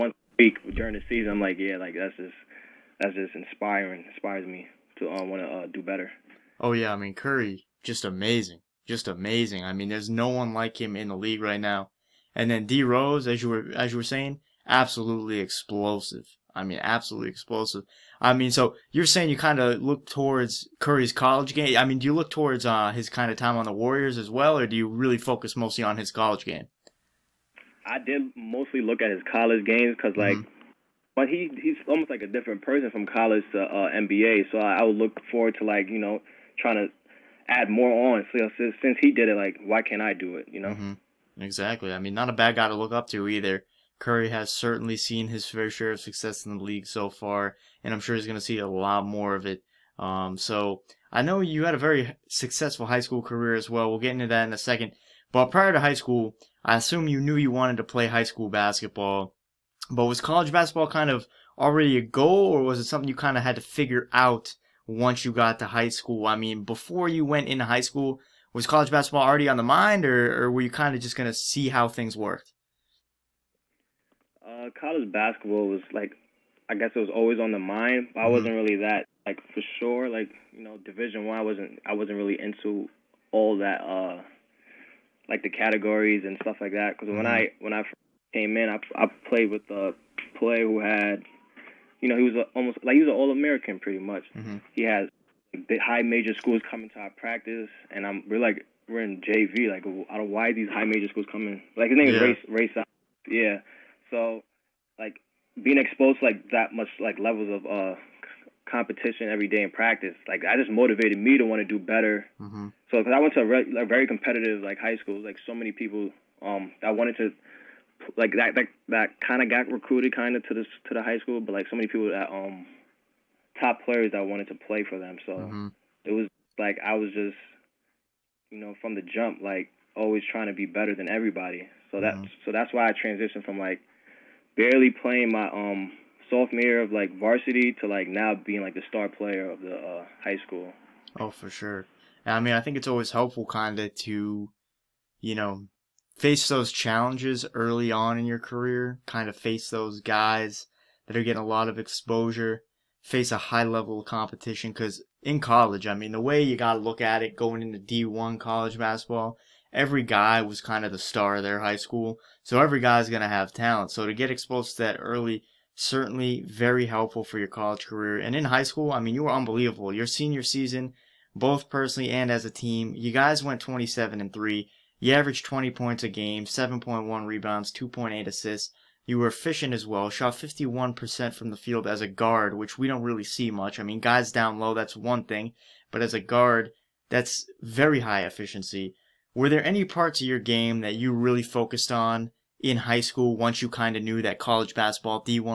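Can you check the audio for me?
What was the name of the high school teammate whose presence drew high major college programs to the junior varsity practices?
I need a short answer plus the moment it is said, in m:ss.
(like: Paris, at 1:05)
Race, at 1:42.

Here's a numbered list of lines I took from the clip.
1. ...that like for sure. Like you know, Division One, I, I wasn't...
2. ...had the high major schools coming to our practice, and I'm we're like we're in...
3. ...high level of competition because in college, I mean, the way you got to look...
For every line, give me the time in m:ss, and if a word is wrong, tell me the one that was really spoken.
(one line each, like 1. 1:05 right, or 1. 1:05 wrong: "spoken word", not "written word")
1. 1:18 right
2. 1:34 right
3. 2:33 right.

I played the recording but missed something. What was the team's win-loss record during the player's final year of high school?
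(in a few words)
27-3.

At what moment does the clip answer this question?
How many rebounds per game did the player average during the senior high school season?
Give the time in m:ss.
2:56.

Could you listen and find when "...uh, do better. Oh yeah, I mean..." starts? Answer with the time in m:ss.
0:05.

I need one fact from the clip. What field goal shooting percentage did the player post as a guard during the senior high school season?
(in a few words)
51%.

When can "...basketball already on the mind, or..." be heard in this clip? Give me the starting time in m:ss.
1:08.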